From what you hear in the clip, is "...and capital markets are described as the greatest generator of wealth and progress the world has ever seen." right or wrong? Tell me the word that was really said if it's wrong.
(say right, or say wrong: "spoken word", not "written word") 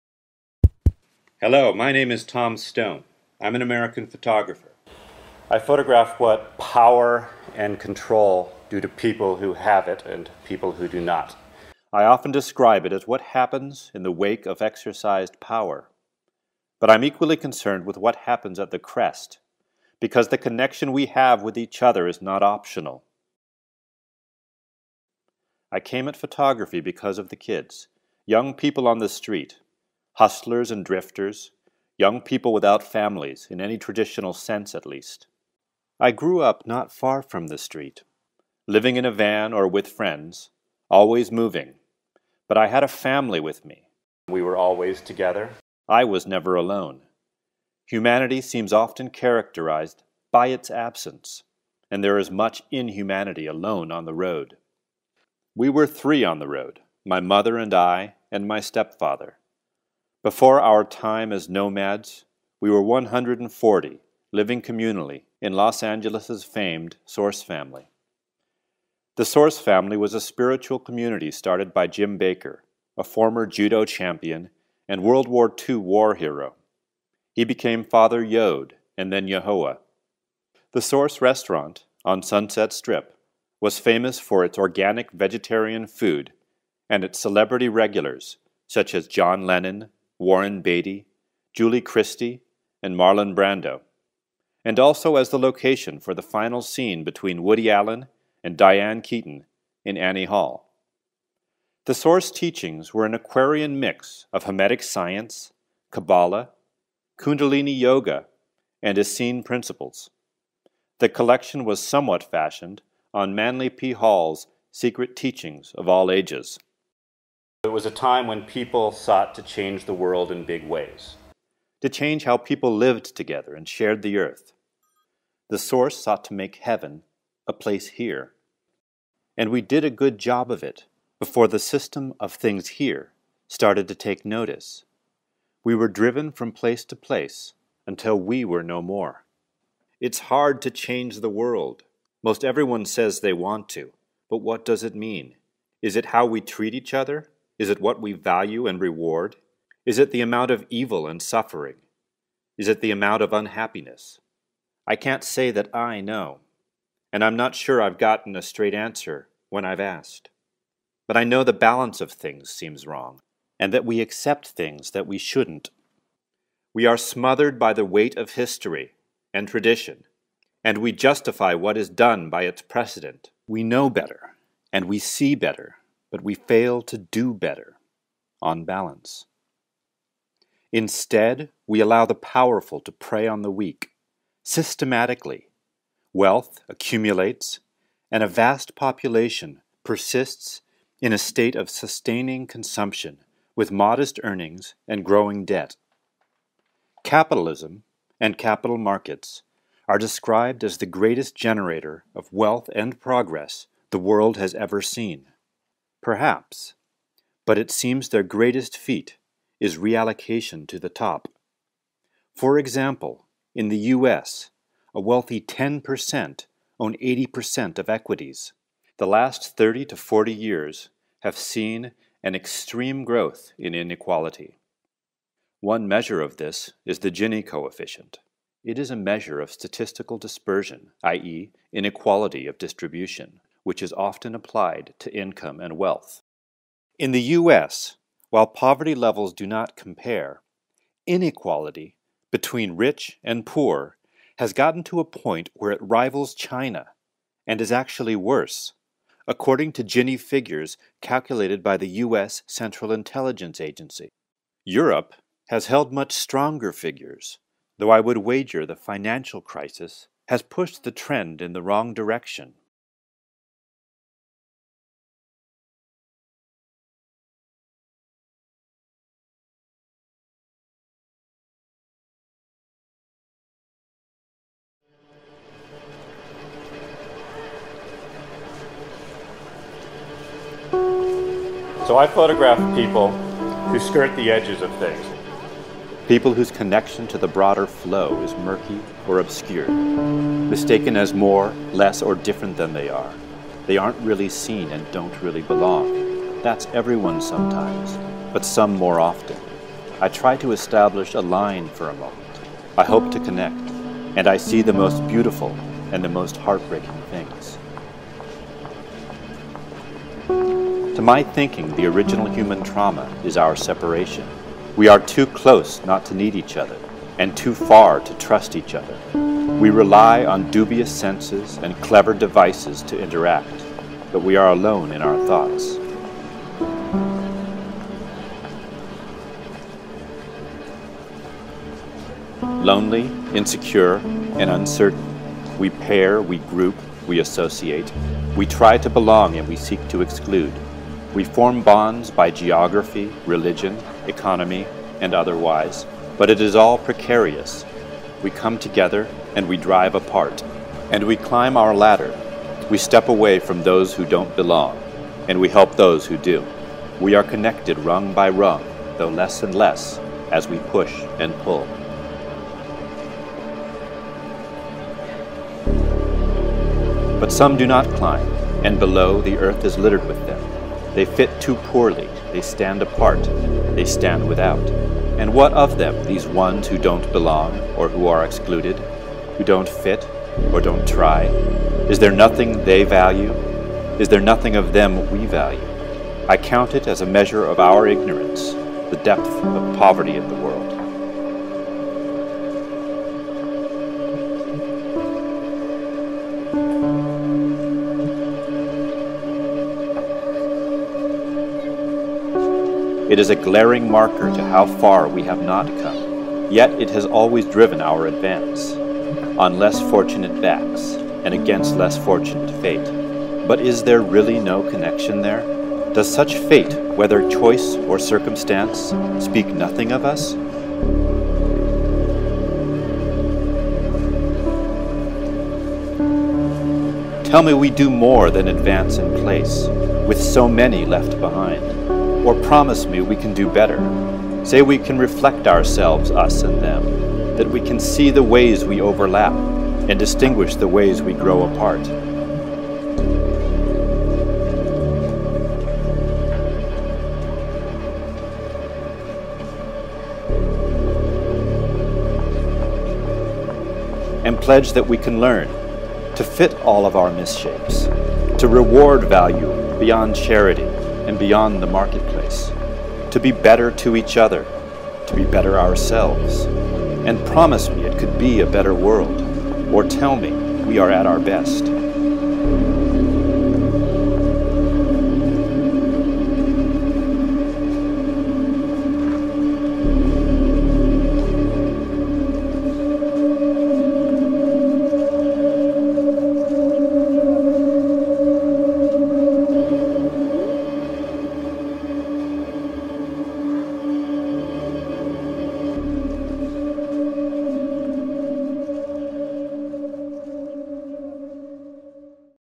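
right.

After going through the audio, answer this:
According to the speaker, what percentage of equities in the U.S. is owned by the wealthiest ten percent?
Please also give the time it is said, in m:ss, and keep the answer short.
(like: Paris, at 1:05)
80%, at 3:36.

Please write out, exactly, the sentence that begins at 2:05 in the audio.
The Source sought to make heaven a place here.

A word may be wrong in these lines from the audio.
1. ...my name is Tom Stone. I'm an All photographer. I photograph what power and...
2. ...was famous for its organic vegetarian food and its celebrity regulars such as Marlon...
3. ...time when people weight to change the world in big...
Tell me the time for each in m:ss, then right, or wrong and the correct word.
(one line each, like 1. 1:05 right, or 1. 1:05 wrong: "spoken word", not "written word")
1. 0:01 wrong: "American", not "All"
2. 1:23 wrong: "John", not "Marlon"
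3. 1:57 wrong: "sought", not "weight".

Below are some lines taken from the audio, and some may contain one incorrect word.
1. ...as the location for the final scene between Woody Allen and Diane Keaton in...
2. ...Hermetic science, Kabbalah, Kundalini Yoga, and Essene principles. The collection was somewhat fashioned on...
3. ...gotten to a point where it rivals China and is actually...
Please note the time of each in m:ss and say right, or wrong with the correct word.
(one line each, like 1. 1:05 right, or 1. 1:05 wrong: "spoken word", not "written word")
1. 1:35 right
2. 1:44 right
3. 4:04 right.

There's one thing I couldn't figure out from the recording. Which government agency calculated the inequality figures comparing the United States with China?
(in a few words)
Central Intelligence Agency.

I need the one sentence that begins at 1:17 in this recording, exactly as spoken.
He became Father Yod and then YaHoWha.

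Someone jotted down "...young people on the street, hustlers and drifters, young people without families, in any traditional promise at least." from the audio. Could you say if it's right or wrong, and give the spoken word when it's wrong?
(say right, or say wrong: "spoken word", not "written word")
wrong: "sense", not "promise".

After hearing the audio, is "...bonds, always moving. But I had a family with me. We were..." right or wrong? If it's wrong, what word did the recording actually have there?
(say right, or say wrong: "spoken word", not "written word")
wrong: "friends", not "bonds".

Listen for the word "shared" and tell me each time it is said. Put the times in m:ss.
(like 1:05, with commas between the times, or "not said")
2:03.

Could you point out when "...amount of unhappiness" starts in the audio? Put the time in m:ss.
2:32.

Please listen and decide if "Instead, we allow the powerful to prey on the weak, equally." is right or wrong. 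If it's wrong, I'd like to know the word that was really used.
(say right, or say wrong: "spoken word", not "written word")
wrong: "systematically", not "equally".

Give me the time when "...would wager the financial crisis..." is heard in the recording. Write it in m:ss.
4:17.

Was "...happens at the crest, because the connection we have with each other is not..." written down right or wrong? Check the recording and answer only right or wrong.
right.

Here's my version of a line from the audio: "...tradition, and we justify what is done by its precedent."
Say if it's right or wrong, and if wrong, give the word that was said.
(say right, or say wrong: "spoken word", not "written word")
right.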